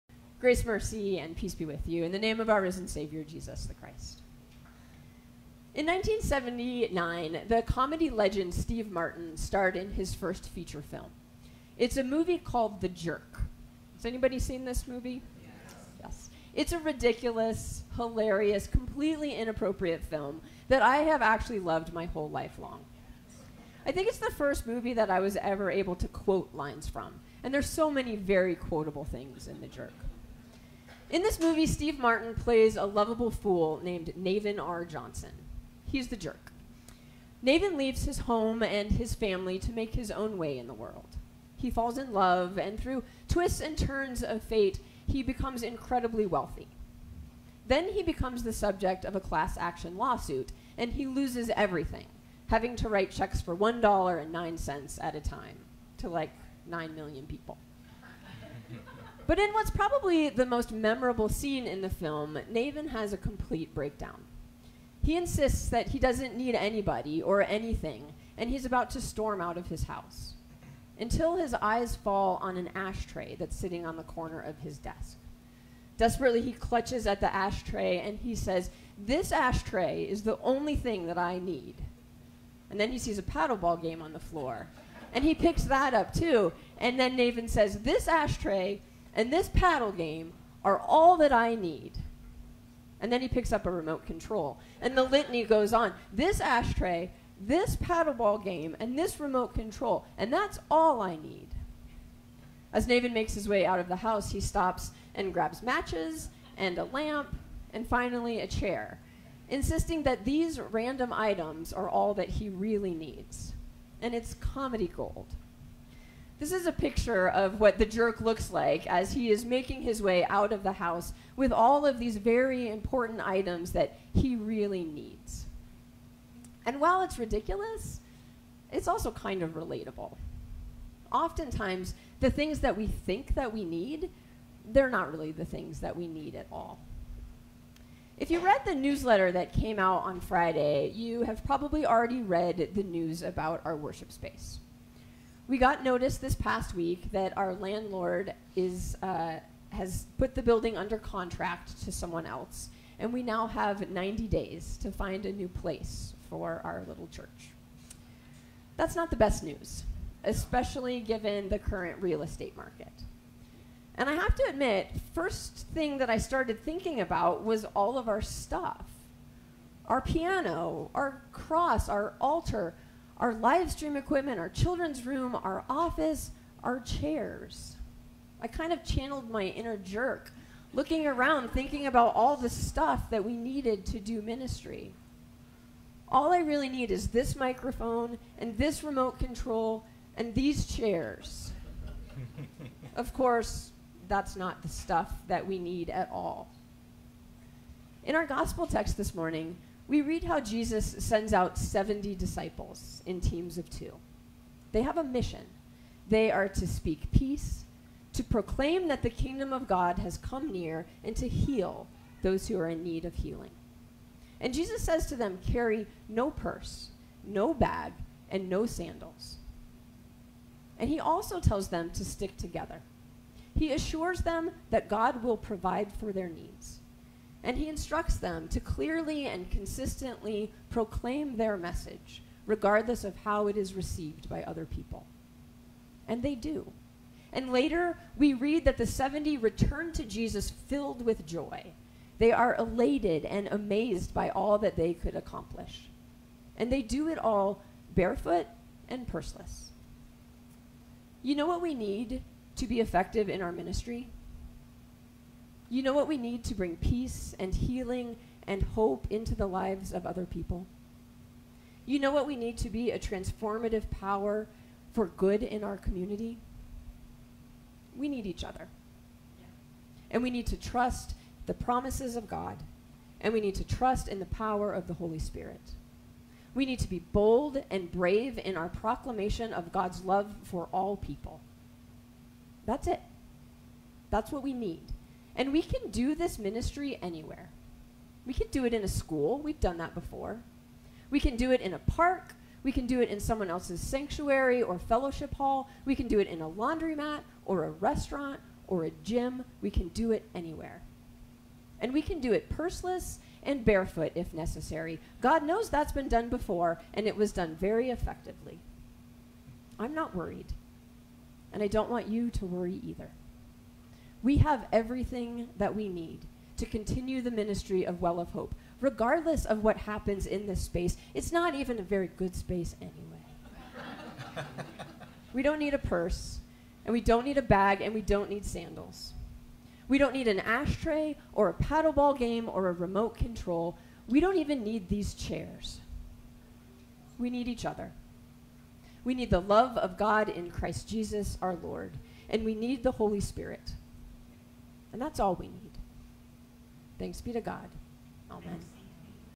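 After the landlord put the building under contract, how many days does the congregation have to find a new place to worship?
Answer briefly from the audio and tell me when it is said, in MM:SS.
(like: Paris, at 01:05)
90, at 02:33.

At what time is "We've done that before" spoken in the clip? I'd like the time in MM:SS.
04:49.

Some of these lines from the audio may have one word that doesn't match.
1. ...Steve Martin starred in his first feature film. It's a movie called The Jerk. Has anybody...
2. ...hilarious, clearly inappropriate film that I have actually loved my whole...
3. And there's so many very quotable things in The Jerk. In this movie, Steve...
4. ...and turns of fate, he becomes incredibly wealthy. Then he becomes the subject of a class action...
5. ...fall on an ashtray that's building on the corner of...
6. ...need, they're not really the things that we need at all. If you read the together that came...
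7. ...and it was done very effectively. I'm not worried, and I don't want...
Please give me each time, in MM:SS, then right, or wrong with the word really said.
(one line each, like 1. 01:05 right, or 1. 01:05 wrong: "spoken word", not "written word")
1. 00:08 right
2. 00:17 wrong: "completely", not "clearly"
3. 00:27 right
4. 00:43 right
5. 01:11 wrong: "sitting", not "building"
6. 02:13 wrong: "newsletter", not "together"
7. 05:06 right.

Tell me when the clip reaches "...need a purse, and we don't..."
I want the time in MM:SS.
05:25.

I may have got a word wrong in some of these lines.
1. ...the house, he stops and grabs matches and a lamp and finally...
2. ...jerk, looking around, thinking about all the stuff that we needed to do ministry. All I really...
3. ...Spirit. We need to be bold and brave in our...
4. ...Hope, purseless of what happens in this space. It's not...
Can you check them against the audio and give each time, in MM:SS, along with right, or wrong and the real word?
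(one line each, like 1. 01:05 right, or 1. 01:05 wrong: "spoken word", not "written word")
1. 01:43 right
2. 02:59 right
3. 04:35 right
4. 05:18 wrong: "regardless", not "purseless".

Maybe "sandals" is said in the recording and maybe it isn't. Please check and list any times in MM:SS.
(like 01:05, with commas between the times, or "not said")
03:38, 05:28.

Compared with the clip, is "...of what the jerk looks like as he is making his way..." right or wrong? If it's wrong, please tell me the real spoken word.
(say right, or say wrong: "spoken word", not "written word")
right.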